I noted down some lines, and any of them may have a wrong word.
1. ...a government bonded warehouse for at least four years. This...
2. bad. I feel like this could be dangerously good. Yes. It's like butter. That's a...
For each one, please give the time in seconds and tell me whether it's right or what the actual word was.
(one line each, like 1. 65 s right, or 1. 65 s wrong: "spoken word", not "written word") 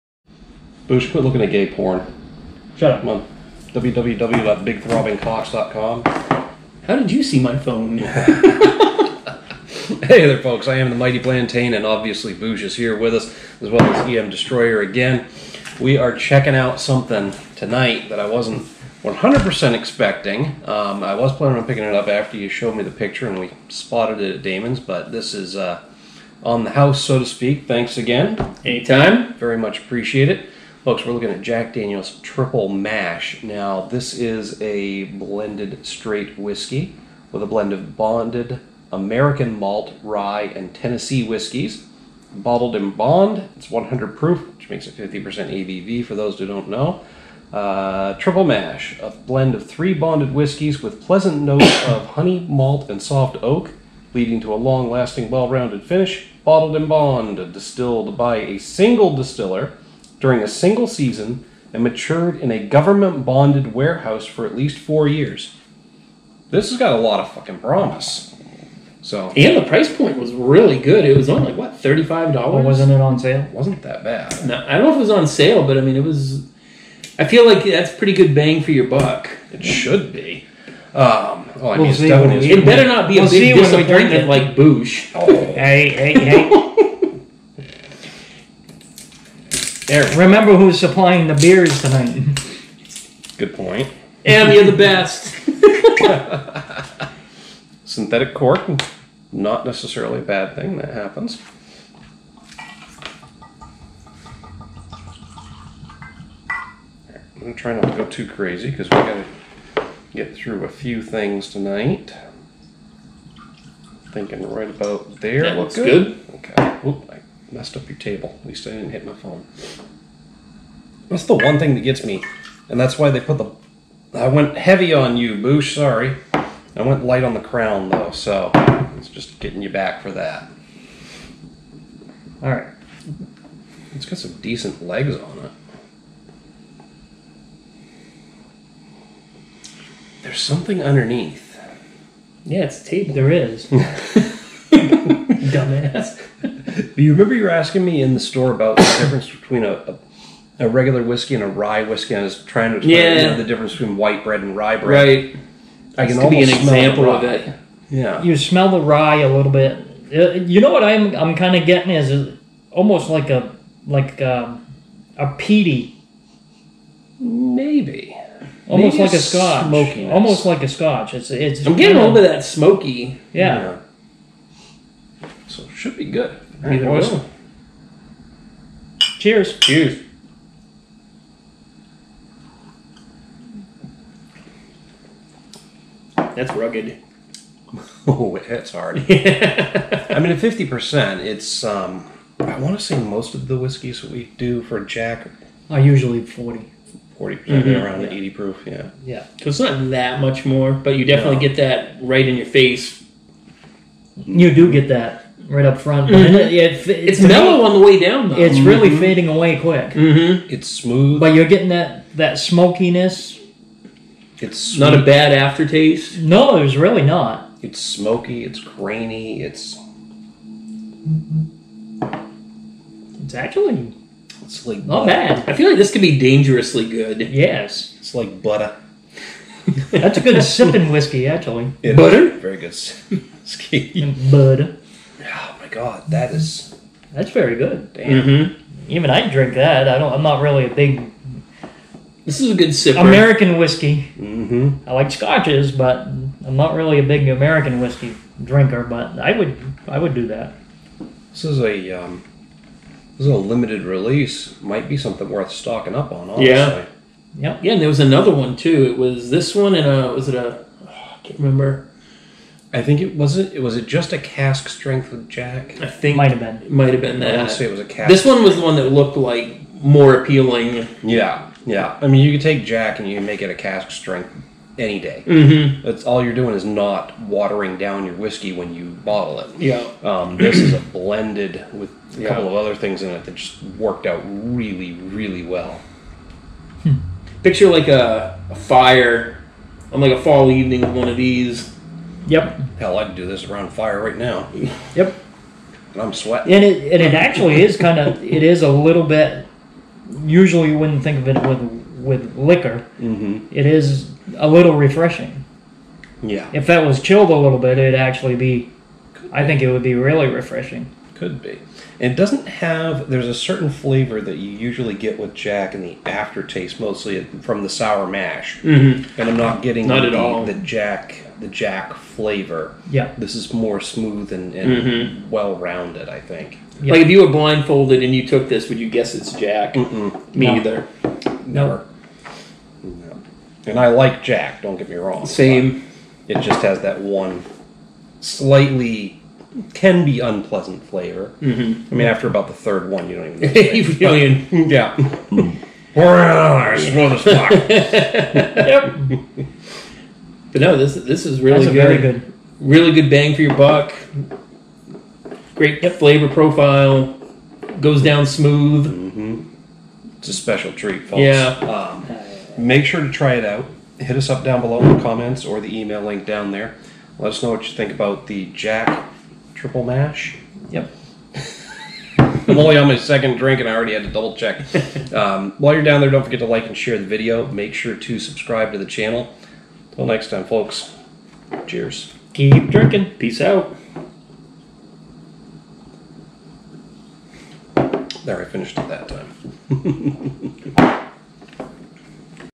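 1. 62 s right
2. 225 s right.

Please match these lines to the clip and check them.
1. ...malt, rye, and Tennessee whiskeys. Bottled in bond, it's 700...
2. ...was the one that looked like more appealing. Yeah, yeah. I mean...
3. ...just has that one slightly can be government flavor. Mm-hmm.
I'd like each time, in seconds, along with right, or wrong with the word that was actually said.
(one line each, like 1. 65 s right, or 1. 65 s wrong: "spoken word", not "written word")
1. 39 s wrong: "100", not "700"
2. 268 s right
3. 336 s wrong: "unpleasant", not "government".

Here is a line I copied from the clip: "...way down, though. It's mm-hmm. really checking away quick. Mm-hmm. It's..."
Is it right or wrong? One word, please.
wrong.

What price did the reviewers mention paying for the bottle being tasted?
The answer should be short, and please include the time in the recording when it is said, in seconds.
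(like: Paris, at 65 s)
$35, at 71 s.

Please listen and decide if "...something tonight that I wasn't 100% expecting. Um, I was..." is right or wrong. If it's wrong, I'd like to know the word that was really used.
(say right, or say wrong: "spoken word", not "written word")
right.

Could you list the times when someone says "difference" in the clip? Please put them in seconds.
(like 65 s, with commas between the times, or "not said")
148 s, 153 s.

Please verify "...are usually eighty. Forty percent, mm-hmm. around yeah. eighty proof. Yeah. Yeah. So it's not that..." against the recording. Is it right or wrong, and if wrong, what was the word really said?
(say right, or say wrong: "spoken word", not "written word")
wrong: "forty", not "eighty".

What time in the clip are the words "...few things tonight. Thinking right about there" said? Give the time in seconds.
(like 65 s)
110 s.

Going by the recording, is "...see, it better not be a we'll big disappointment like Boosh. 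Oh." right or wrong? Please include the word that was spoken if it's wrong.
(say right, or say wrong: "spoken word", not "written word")
right.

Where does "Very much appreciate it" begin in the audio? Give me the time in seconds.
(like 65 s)
29 s.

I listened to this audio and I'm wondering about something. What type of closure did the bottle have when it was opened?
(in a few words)
Synthetic cork.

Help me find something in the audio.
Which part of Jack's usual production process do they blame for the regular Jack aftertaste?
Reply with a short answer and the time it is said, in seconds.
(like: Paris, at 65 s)
the sour mash, at 317 s.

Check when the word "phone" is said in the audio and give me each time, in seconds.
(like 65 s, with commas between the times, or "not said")
7 s, 119 s.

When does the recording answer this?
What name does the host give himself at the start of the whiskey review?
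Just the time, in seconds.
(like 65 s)
10 s.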